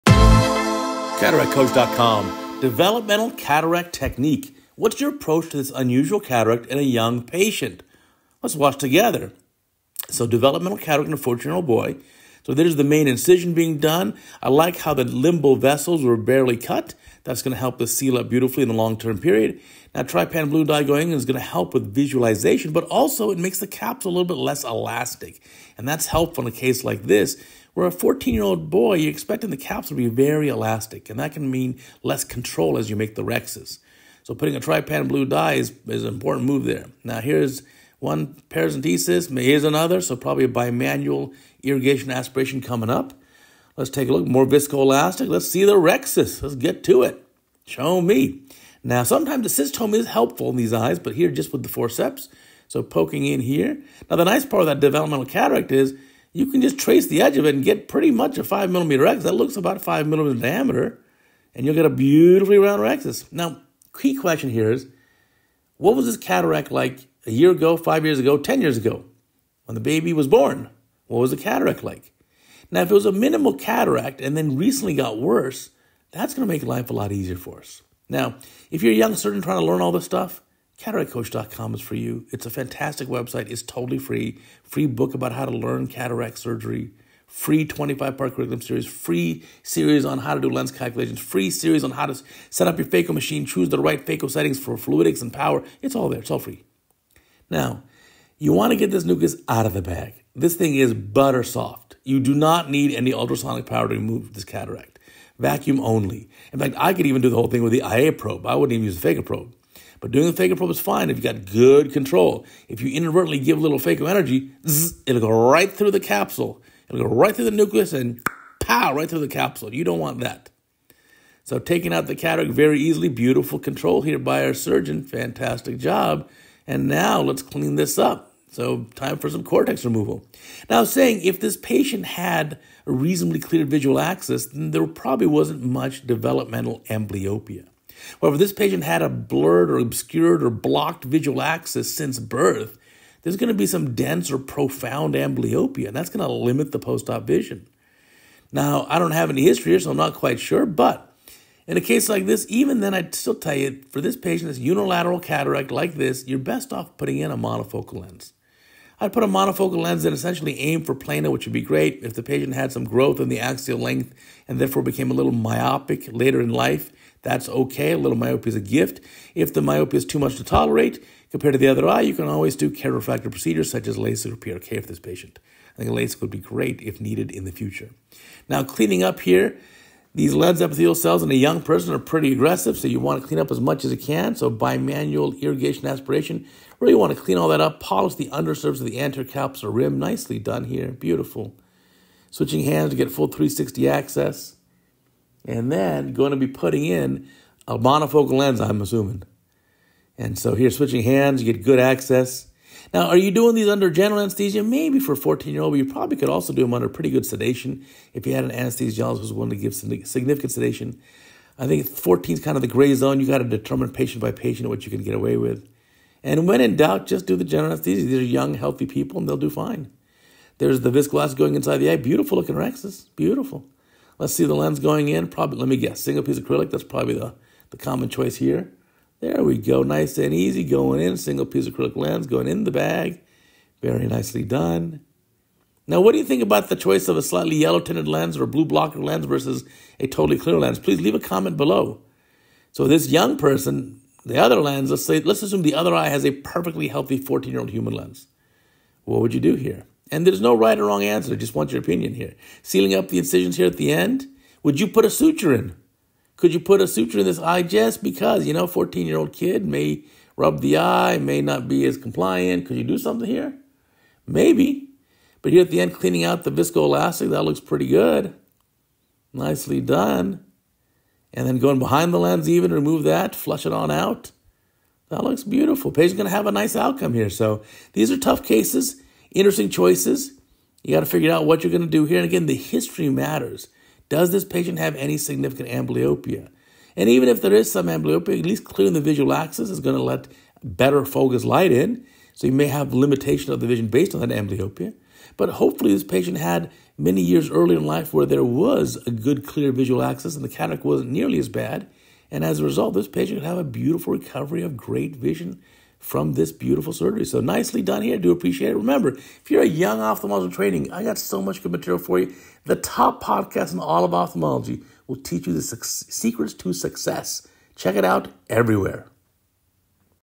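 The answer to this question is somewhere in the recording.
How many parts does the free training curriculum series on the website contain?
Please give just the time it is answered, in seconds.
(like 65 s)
87 s.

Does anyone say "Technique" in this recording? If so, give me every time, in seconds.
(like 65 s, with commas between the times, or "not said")
3 s.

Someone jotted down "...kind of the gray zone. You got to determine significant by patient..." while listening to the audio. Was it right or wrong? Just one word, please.
wrong.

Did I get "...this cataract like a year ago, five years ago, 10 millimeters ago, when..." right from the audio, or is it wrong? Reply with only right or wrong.
wrong.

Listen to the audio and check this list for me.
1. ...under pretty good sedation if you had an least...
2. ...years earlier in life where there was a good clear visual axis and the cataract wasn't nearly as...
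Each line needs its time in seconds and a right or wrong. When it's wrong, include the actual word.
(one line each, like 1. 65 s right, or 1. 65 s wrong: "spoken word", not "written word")
1. 206 s wrong: "anesthesiologist", not "least"
2. 297 s right.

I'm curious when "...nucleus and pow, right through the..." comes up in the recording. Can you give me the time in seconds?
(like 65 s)
117 s.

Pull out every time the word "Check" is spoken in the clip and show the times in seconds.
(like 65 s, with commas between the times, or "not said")
317 s.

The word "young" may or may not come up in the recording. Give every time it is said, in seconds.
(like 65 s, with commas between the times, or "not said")
6 s, 78 s, 181 s, 218 s, 243 s, 309 s.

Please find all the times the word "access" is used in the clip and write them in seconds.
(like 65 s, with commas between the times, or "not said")
193 s, 201 s.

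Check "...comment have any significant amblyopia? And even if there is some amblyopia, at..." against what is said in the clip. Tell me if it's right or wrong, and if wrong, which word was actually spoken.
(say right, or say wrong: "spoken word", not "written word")
wrong: "patient", not "comment".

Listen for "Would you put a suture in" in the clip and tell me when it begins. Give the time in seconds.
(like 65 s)
254 s.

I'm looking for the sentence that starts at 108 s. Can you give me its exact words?
I wouldn't even use the phaco probe.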